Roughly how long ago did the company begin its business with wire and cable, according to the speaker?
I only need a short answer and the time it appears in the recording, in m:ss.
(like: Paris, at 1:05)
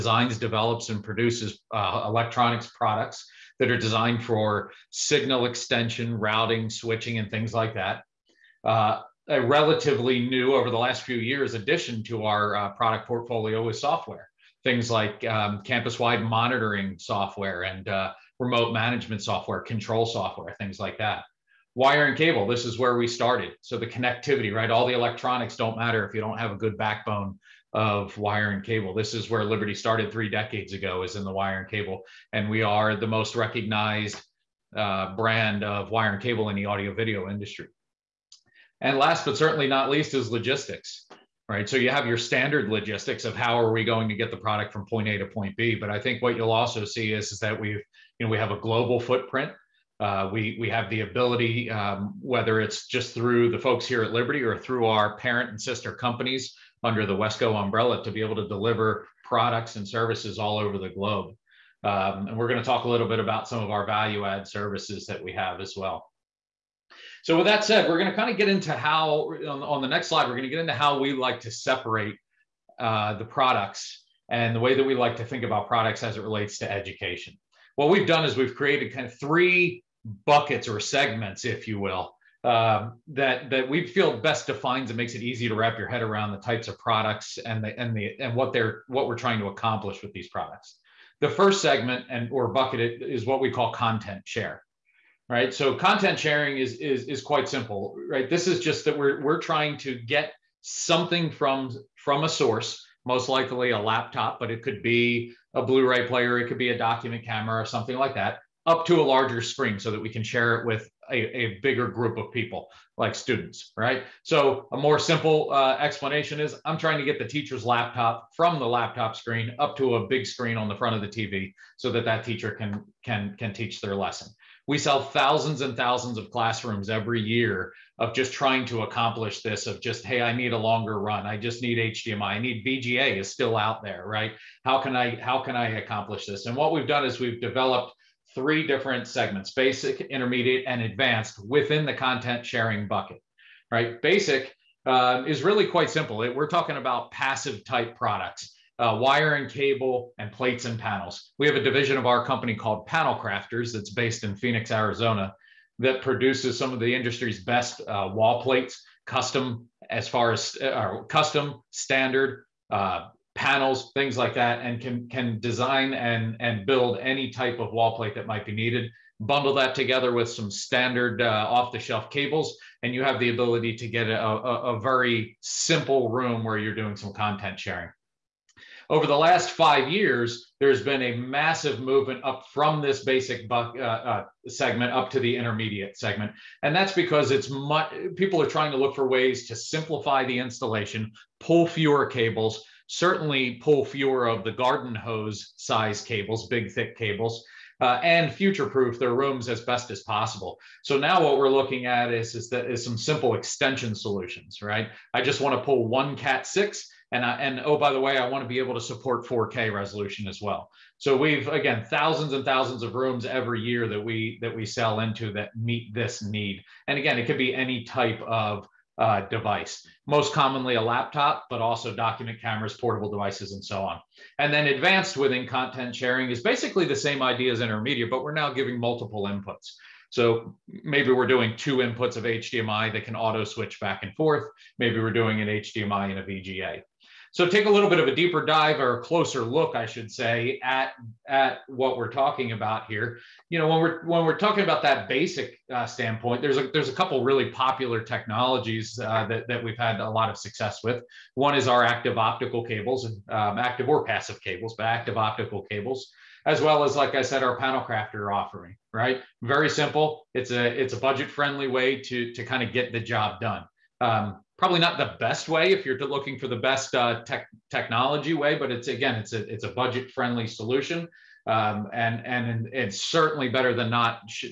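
3 decades, at 0:30.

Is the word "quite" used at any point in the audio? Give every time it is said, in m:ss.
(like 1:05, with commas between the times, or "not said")
1:37, 2:25.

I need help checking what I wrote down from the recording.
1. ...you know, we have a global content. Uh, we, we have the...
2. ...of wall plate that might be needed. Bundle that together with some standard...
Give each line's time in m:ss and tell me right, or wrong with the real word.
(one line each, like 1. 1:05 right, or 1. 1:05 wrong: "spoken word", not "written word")
1. 0:48 wrong: "footprint", not "content"
2. 2:47 right.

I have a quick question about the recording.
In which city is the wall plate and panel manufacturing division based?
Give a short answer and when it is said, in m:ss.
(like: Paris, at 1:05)
Phoenix, Arizona, at 2:34.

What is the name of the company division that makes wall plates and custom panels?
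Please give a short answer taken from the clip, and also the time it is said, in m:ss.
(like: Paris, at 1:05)
Panel Crafters, at 2:32.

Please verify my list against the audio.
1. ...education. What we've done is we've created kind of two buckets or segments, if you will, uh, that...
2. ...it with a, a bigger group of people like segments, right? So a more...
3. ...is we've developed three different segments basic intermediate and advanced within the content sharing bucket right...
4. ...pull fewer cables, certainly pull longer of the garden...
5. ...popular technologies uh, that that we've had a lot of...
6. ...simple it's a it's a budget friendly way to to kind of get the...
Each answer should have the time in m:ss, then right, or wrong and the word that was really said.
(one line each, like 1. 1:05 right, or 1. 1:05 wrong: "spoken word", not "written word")
1. 1:16 wrong: "three", not "two"
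2. 1:50 wrong: "students", not "segments"
3. 2:17 right
4. 3:11 wrong: "fewer", not "longer"
5. 4:07 right
6. 4:19 right.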